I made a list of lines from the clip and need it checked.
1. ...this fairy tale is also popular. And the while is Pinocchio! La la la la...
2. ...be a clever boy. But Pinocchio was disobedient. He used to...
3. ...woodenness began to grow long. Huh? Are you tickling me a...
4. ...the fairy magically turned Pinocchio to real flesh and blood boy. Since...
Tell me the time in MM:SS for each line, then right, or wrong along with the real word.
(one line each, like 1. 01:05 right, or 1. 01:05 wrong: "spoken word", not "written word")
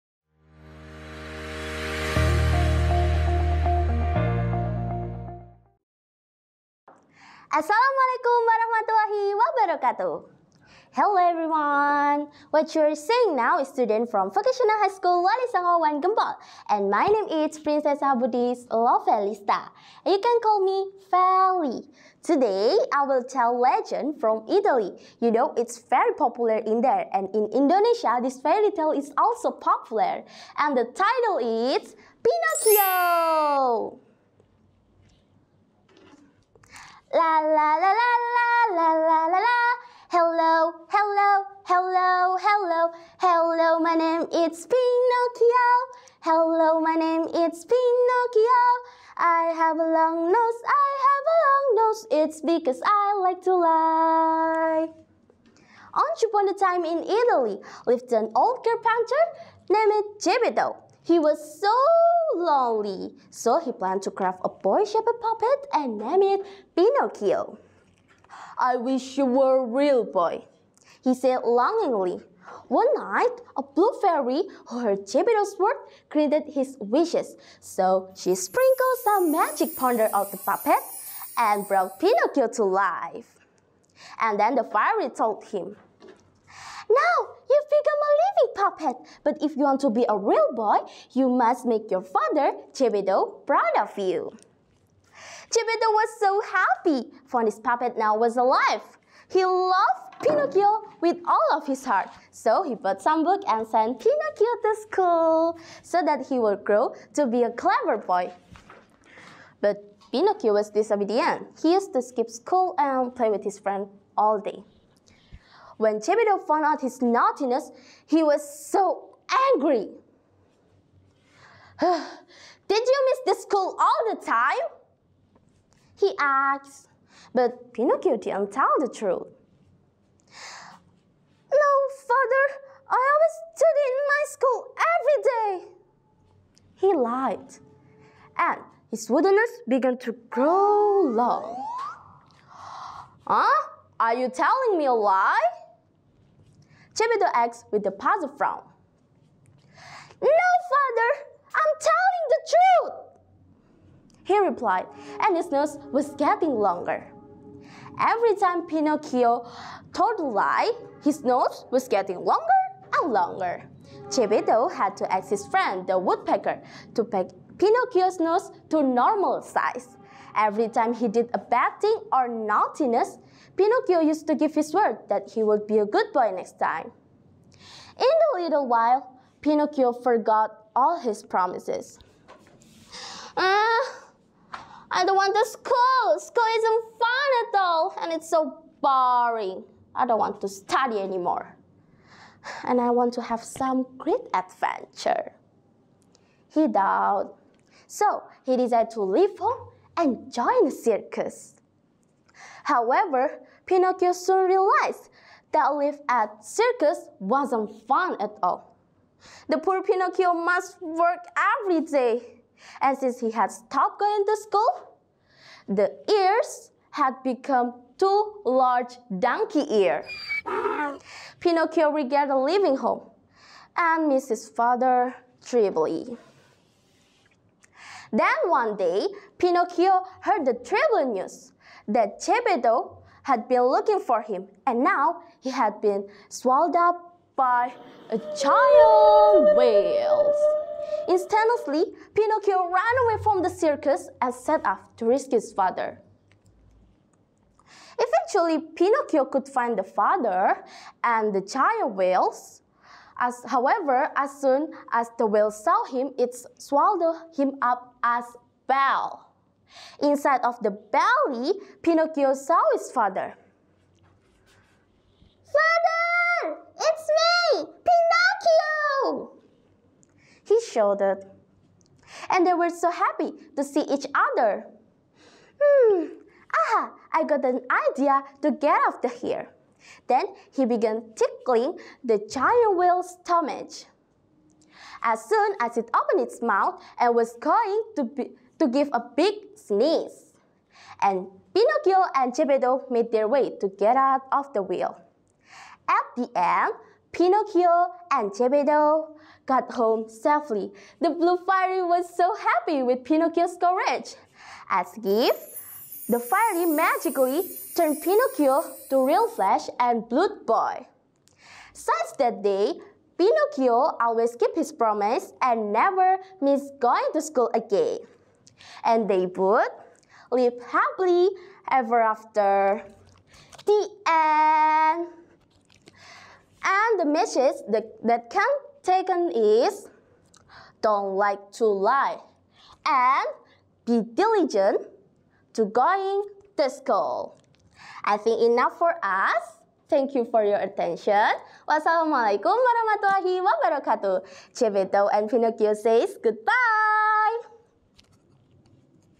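1. 00:28 wrong: "title", not "while"
2. 01:47 right
3. 02:19 wrong: "telling", not "tickling"
4. 05:06 right.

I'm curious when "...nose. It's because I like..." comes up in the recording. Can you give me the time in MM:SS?
00:51.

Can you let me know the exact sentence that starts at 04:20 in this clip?
Inside of the belly, Pinocchio saw his father.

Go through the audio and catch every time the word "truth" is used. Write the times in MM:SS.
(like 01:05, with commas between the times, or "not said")
02:08, 02:32.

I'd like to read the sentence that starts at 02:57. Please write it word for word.
In a little while, Pinocchio forgot all his promises.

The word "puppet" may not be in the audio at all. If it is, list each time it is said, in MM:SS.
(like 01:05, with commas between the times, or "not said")
01:05, 01:20, 01:28, 01:37.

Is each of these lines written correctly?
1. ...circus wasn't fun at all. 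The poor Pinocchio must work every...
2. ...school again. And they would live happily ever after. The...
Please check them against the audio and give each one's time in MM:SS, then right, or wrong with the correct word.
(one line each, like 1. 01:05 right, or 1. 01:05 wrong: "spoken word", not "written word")
1. 03:26 right
2. 05:17 right.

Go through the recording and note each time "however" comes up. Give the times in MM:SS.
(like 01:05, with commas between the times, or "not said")
03:22, 04:13.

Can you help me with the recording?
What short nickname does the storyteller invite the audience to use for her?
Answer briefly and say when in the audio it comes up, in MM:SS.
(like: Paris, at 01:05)
Feli, at 00:21.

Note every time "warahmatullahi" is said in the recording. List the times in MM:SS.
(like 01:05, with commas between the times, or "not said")
00:08, 05:42.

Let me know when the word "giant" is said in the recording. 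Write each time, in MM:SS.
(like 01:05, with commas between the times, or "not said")
03:58, 04:11, 04:42.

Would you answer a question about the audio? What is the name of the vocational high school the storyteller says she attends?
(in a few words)
Wali Wan Gempol.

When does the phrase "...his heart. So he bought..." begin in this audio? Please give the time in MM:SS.
01:41.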